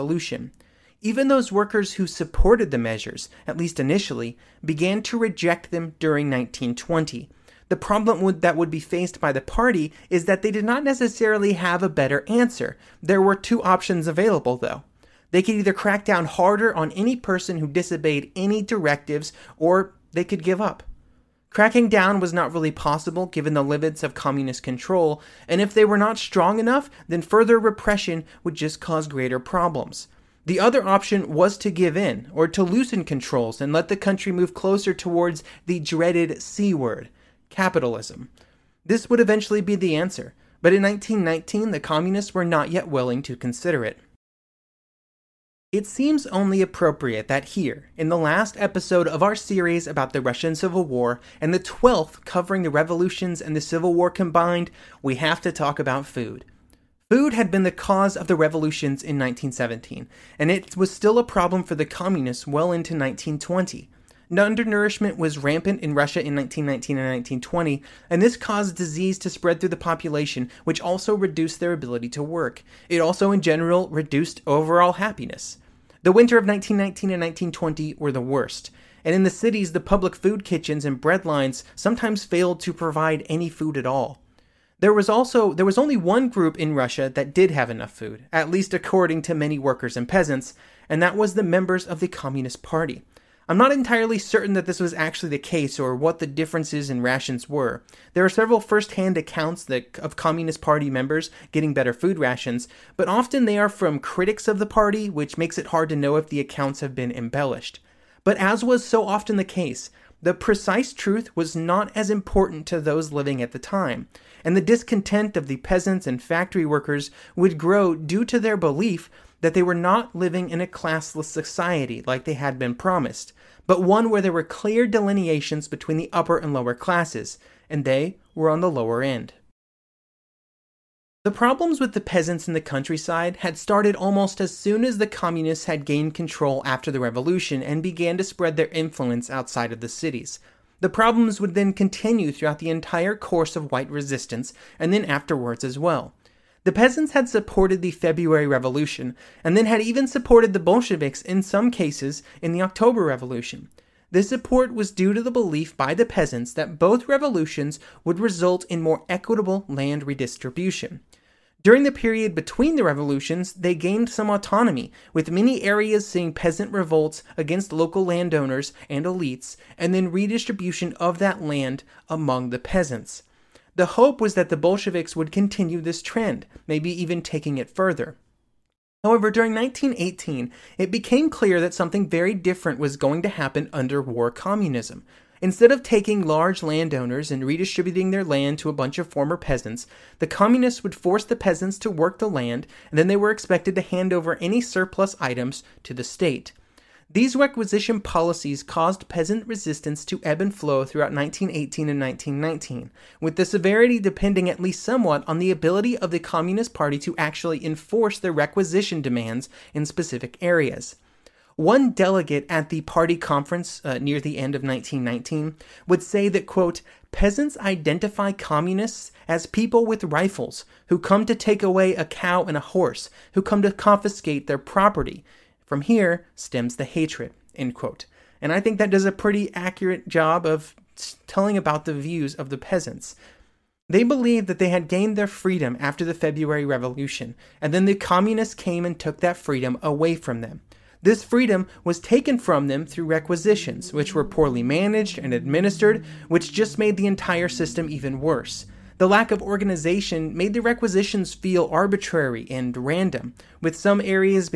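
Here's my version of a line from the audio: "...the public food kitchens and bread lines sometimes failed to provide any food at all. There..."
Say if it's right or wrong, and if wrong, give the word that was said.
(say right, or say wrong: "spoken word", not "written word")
right.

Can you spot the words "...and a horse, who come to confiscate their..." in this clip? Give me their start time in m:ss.
3:42.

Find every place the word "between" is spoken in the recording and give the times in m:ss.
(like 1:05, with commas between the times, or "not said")
2:05, 2:42.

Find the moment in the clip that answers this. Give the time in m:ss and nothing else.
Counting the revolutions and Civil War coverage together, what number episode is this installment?
0:51.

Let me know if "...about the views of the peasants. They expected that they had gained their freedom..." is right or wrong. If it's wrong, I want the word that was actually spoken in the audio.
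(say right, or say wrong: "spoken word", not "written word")
wrong: "believed", not "expected".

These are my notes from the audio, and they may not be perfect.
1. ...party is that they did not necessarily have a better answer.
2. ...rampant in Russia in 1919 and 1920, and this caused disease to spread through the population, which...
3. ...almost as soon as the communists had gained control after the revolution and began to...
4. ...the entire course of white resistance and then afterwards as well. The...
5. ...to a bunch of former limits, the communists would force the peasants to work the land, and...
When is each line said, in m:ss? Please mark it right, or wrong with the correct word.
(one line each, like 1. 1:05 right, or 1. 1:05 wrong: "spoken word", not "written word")
1. 0:09 right
2. 1:05 right
3. 2:13 right
4. 2:22 right
5. 3:08 wrong: "peasants", not "limits".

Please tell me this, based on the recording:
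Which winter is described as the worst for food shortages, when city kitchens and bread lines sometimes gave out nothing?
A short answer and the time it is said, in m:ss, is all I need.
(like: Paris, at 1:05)
1919 and 1920, at 1:16.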